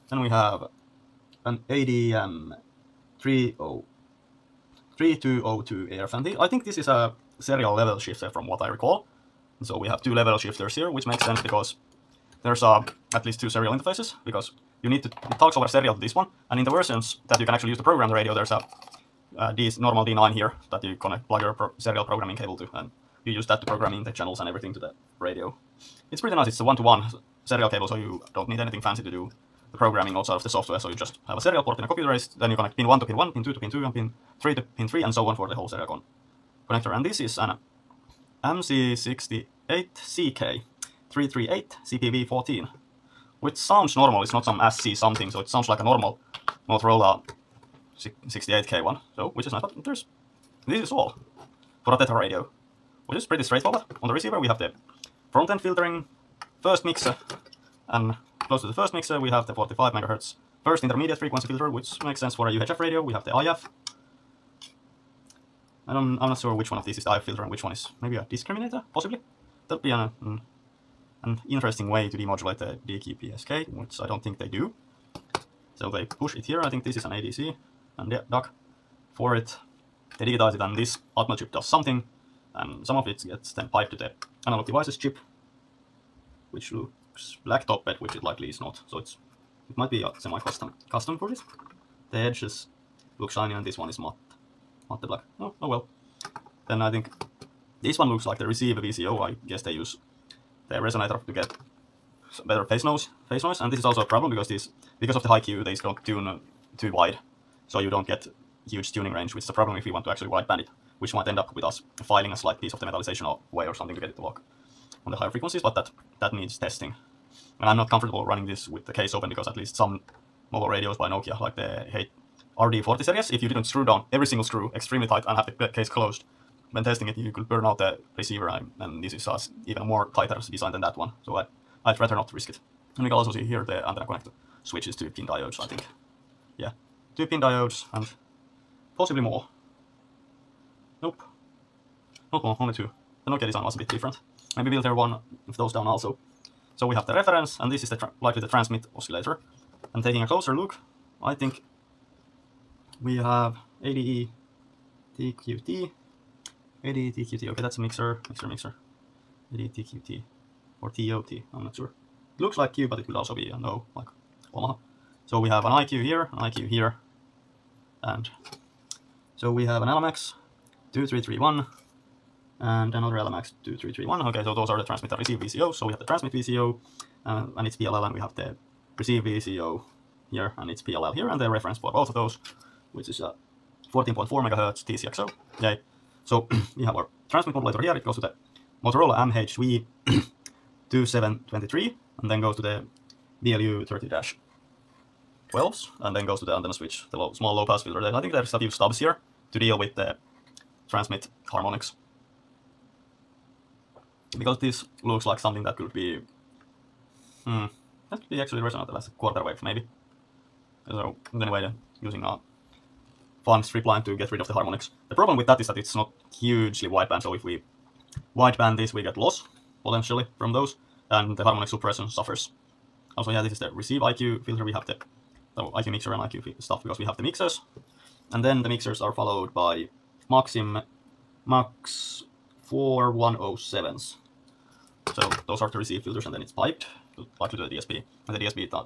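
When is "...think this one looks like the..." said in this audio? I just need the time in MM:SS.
01:36.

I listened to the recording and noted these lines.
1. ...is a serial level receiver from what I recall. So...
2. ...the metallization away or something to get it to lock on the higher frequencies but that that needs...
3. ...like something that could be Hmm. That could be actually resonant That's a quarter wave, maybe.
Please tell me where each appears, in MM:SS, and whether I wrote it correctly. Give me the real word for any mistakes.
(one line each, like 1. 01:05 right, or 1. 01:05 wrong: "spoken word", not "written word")
1. 00:06 wrong: "shifter", not "receiver"
2. 01:52 right
3. 03:25 right.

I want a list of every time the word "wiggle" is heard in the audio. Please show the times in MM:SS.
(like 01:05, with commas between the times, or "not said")
not said.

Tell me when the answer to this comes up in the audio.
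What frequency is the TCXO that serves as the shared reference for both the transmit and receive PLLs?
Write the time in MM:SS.
03:03.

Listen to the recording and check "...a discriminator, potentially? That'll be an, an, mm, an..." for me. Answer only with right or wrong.
wrong.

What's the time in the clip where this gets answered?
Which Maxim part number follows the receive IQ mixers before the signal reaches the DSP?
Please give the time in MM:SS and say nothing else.
03:51.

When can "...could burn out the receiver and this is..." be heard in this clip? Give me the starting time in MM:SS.
02:07.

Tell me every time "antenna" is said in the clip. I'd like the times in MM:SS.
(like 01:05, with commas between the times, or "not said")
02:13, 03:16.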